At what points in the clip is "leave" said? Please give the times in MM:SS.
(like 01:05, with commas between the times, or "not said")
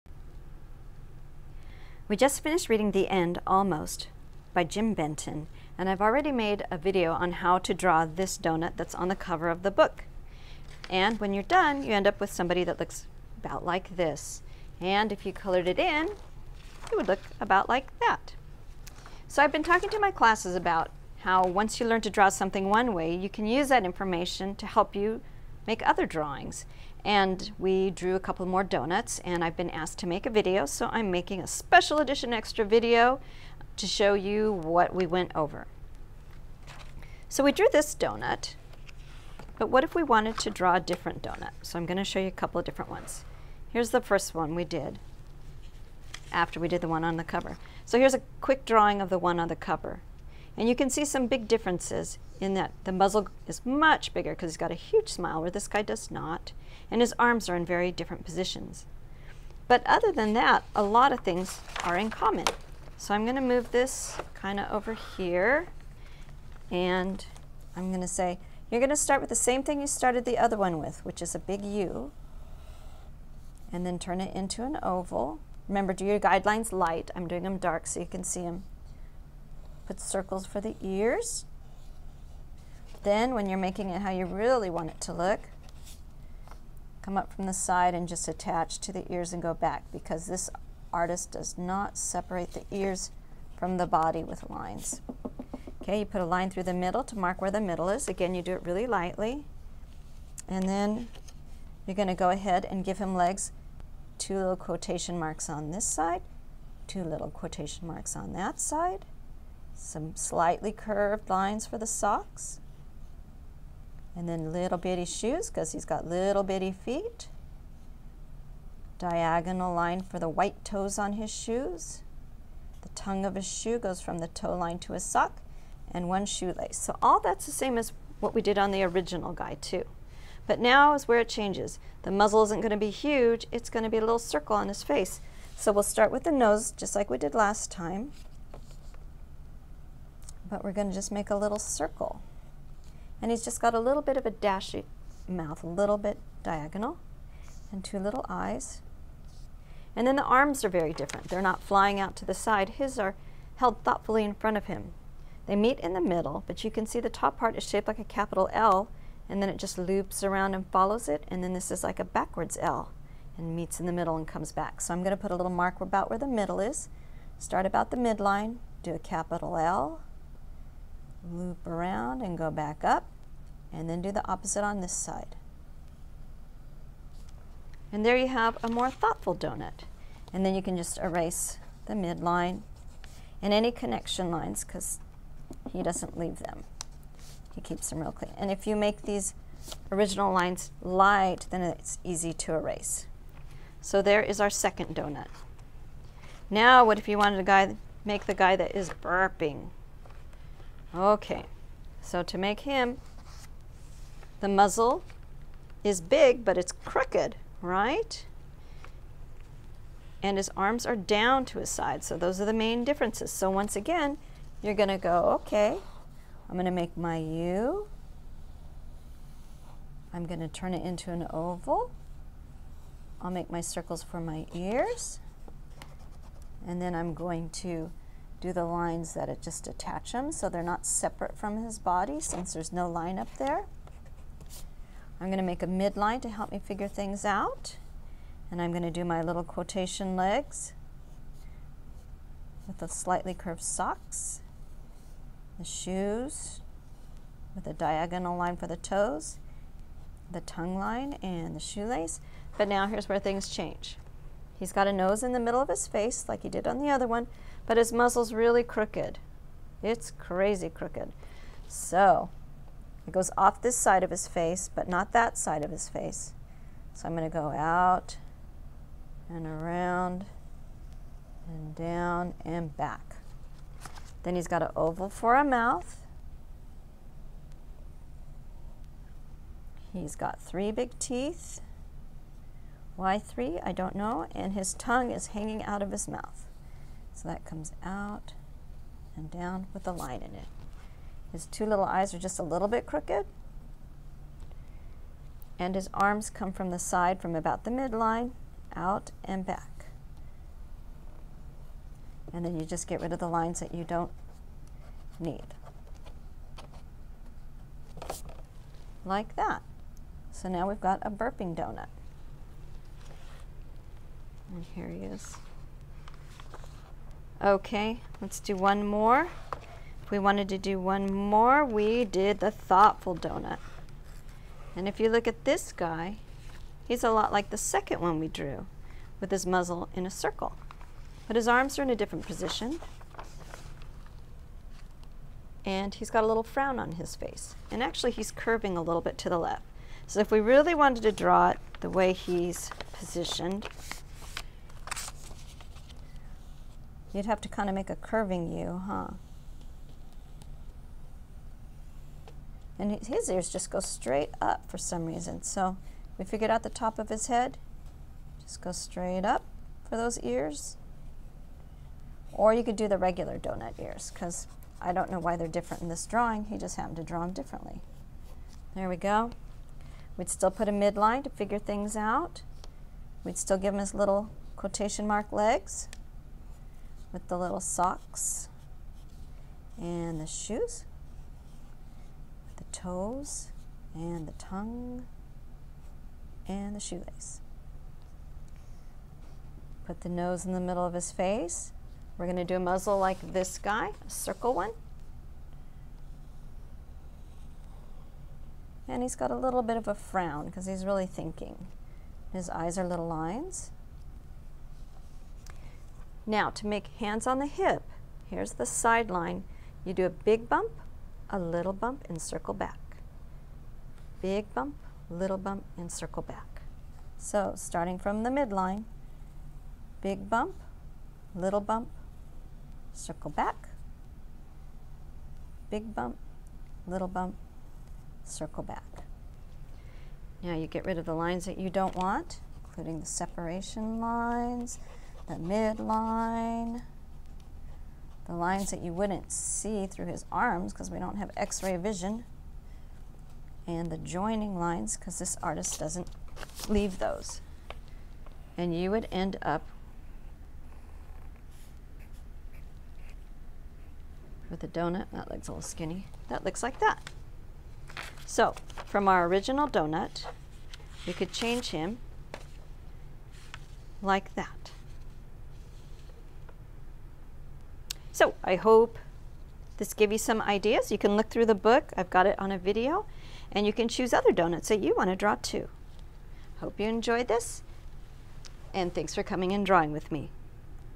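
03:06, 07:26.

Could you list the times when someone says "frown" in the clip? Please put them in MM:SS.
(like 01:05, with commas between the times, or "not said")
05:36, 06:39.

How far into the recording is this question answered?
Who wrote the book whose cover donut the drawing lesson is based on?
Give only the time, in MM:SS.
00:04.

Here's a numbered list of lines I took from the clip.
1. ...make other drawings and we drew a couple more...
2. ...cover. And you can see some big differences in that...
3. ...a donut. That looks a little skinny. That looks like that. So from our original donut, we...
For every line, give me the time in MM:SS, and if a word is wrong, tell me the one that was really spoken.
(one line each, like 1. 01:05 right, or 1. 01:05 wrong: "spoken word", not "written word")
1. 00:25 right
2. 00:49 right
3. 07:34 right.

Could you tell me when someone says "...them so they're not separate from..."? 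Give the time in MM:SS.
03:50.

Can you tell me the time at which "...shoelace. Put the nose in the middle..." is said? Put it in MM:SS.
06:26.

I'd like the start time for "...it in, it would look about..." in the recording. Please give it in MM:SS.
00:15.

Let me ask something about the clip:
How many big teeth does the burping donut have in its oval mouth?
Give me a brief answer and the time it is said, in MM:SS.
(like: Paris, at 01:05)
3, at 04:40.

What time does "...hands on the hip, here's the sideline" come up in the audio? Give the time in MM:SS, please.
06:46.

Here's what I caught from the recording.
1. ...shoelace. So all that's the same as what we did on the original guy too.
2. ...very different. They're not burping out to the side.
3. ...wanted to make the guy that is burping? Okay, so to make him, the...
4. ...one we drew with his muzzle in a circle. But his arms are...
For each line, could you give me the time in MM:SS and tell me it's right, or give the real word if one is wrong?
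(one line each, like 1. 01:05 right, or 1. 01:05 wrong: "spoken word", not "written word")
1. 02:06 right
2. 02:30 wrong: "flying", not "burping"
3. 03:17 right
4. 05:28 right.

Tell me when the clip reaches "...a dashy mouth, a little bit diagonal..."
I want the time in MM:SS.
02:24.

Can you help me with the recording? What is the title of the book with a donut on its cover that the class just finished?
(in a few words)
The End Almost.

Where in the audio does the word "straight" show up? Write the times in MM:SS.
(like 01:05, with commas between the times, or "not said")
05:53, 05:58.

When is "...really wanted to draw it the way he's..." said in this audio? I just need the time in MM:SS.
05:40.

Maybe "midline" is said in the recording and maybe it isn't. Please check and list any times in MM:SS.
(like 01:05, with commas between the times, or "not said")
02:47, 03:01, 03:55, 04:57, 06:10, 06:58, 07:15.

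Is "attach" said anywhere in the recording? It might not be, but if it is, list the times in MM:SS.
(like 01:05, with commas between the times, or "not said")
01:28, 03:49.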